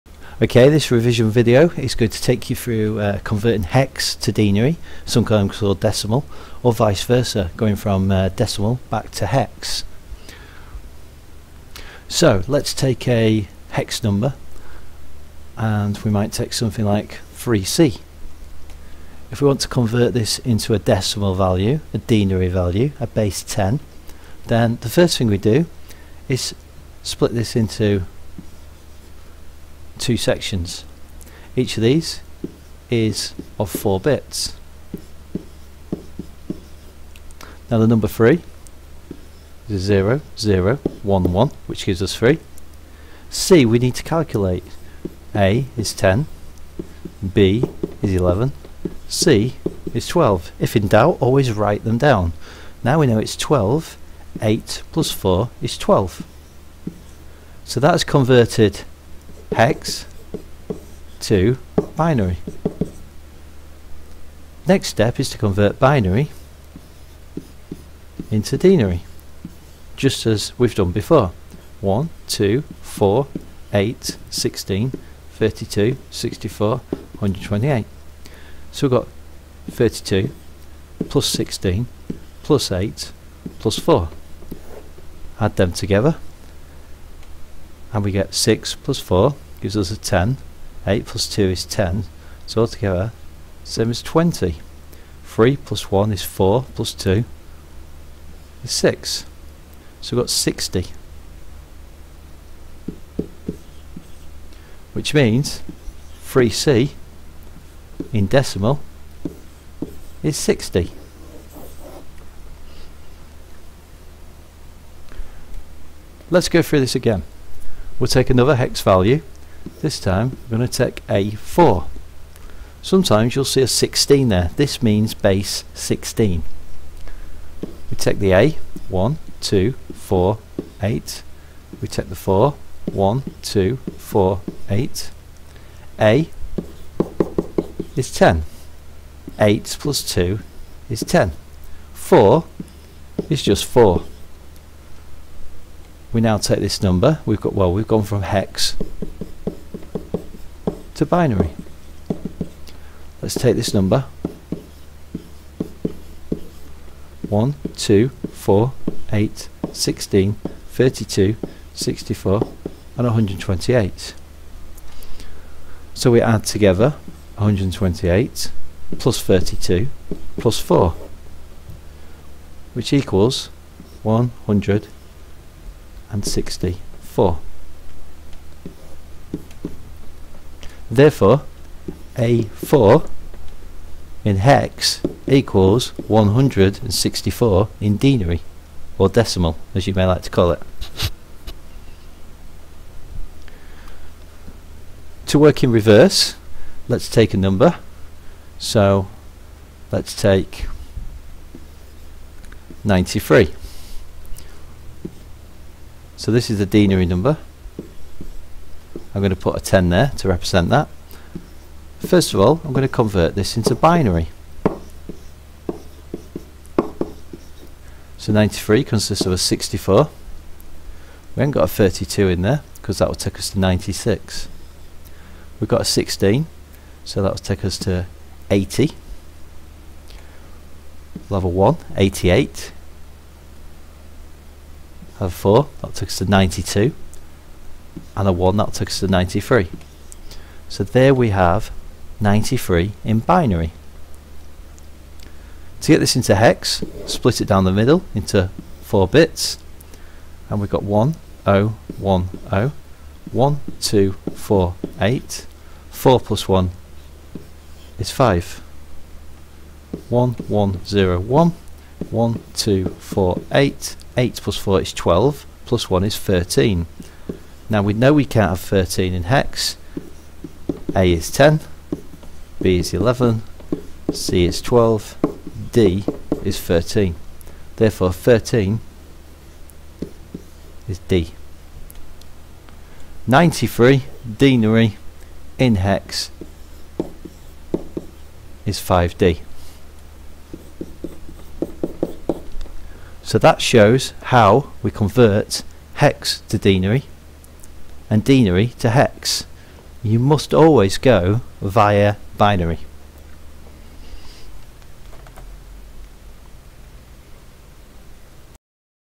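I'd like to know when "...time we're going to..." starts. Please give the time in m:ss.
1:59.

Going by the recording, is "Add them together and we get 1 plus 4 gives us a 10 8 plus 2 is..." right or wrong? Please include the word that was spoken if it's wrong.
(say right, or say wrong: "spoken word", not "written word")
wrong: "6", not "1".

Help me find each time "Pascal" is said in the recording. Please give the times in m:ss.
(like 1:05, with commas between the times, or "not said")
not said.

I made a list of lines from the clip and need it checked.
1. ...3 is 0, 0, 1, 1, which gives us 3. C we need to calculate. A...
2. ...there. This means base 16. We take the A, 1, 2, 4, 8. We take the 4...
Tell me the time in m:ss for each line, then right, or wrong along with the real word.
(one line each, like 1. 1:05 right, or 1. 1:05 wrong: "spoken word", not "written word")
1. 0:38 right
2. 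2:04 right.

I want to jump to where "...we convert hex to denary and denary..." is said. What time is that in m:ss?
4:54.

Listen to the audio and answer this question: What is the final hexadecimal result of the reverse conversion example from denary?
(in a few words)
5D.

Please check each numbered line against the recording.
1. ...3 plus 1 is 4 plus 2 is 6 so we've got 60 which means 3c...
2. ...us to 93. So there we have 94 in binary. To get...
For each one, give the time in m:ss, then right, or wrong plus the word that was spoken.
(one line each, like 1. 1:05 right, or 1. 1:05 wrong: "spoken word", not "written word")
1. 1:35 right
2. 3:58 wrong: "93", not "94".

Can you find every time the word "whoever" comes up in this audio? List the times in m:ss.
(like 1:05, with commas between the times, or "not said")
not said.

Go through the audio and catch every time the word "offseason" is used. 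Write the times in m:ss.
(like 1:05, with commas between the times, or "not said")
not said.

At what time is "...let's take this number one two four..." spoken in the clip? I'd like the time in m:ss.
2:33.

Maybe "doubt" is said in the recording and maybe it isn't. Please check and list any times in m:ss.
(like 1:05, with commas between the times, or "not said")
0:50.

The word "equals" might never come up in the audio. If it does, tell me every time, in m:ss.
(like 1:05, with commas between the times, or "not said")
2:52, 3:05.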